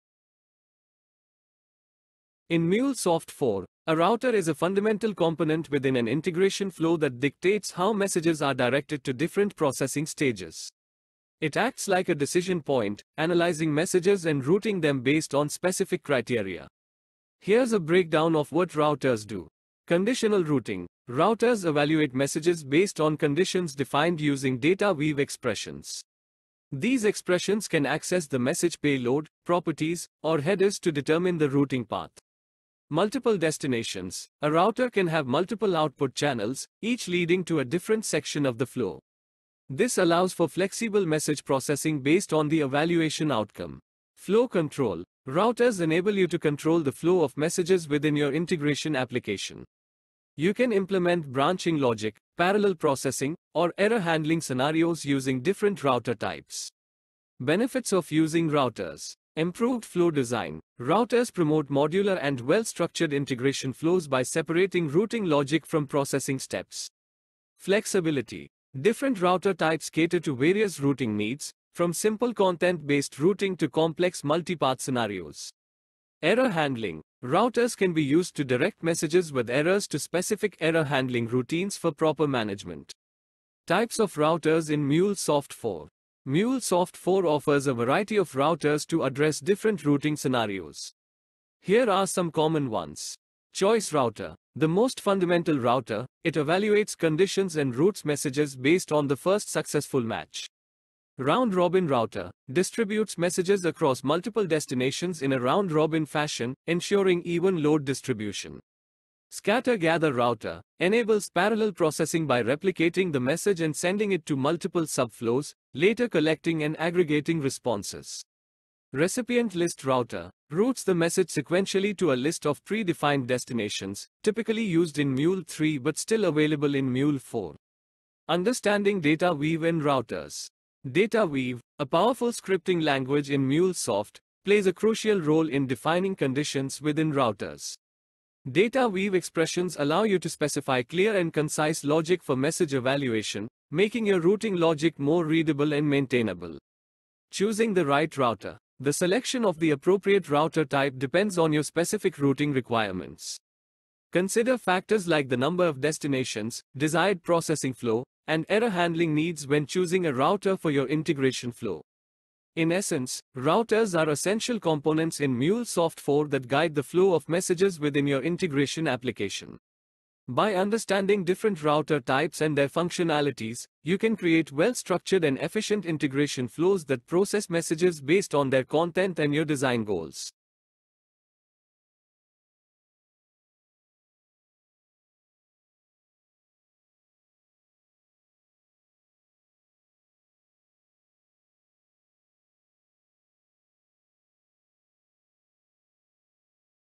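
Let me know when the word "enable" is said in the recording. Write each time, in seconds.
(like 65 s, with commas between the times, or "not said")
45 s, 110 s.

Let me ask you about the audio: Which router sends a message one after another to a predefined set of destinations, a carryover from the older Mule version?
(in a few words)
Recipient list router.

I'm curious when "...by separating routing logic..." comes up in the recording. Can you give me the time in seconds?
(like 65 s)
64 s.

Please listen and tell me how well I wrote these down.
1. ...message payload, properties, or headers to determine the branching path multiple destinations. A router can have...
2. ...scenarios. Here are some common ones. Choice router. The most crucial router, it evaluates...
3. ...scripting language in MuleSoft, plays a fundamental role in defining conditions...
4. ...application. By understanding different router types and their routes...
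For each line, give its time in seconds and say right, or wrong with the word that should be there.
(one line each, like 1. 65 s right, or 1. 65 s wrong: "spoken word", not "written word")
1. 28 s wrong: "routing", not "branching"
2. 90 s wrong: "fundamental", not "crucial"
3. 132 s wrong: "crucial", not "fundamental"
4. 168 s wrong: "functionalities", not "routes".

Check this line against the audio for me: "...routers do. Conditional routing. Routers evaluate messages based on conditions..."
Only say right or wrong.
right.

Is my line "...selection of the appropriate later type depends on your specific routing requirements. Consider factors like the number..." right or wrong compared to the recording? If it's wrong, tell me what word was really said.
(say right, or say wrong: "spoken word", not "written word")
wrong: "router", not "later".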